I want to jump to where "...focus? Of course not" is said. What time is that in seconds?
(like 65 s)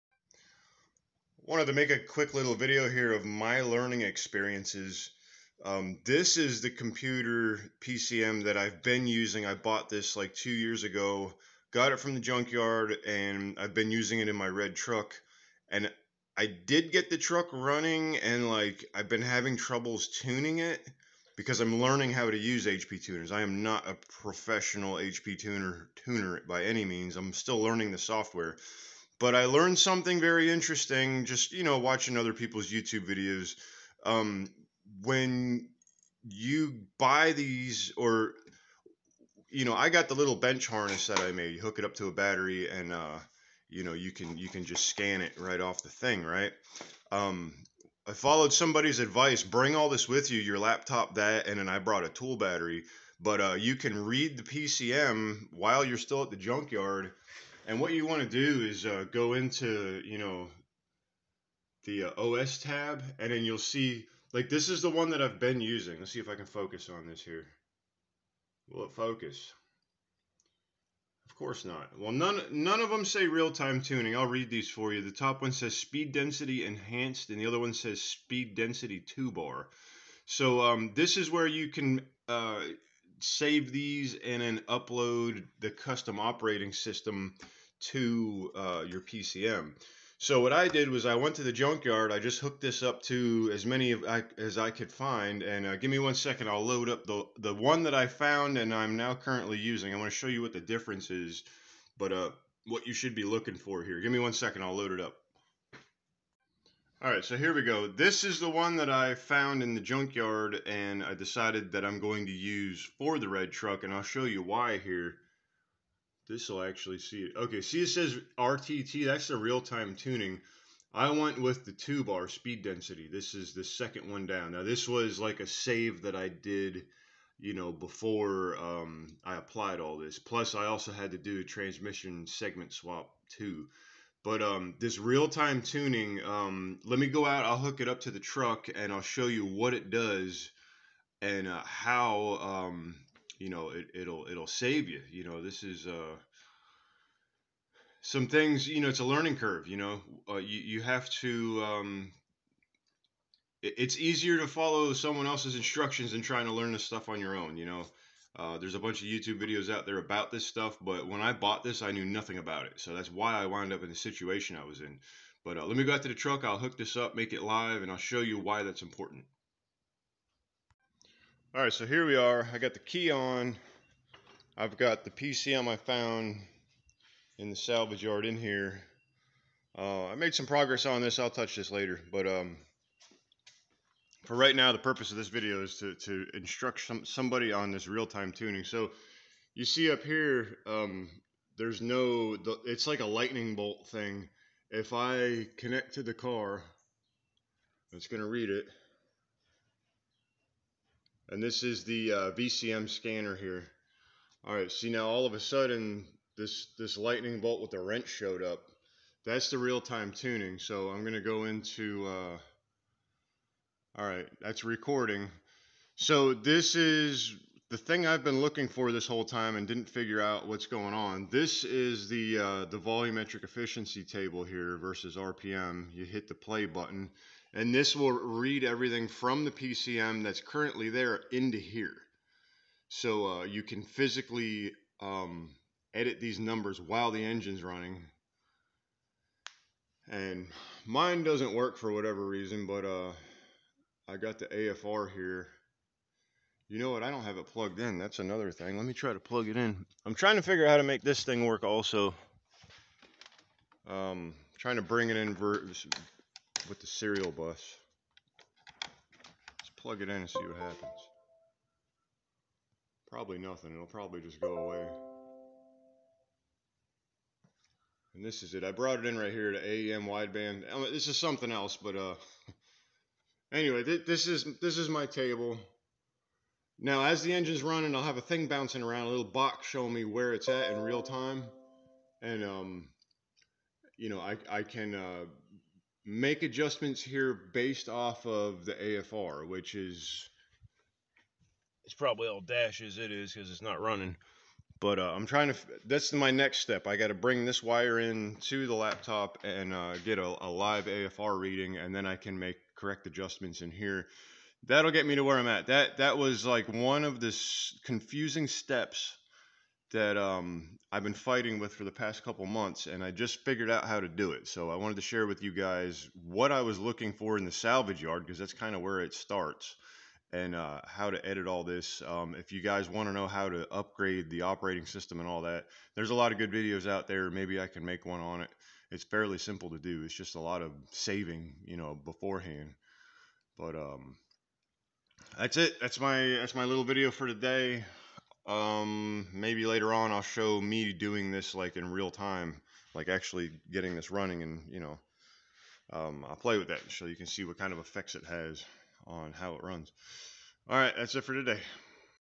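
68 s.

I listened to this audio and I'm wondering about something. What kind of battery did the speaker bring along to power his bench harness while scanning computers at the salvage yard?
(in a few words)
A tool battery.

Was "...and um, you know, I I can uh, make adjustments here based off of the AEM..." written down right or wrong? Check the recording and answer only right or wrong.
wrong.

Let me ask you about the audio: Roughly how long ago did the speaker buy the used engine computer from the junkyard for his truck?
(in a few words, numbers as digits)
2 years ago.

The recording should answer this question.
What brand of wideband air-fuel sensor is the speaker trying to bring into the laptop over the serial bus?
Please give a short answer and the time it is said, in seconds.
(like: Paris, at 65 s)
AEM, at 269 s.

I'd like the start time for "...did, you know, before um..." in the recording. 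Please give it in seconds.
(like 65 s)
126 s.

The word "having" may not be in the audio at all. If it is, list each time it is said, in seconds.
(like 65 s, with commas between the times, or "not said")
19 s.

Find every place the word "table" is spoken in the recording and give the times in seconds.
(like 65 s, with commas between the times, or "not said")
224 s, 275 s.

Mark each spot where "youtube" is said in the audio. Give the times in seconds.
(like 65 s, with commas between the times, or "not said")
32 s, 159 s.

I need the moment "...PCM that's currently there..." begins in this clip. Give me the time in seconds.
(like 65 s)
229 s.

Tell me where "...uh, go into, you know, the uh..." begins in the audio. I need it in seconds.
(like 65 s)
58 s.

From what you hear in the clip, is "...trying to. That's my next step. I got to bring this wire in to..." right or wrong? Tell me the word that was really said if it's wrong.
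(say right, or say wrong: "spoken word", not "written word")
right.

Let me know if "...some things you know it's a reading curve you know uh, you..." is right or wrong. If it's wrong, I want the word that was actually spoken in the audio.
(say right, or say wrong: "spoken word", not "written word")
wrong: "learning", not "reading".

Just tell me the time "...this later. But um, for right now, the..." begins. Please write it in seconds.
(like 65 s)
181 s.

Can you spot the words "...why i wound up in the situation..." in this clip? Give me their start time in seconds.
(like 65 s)
163 s.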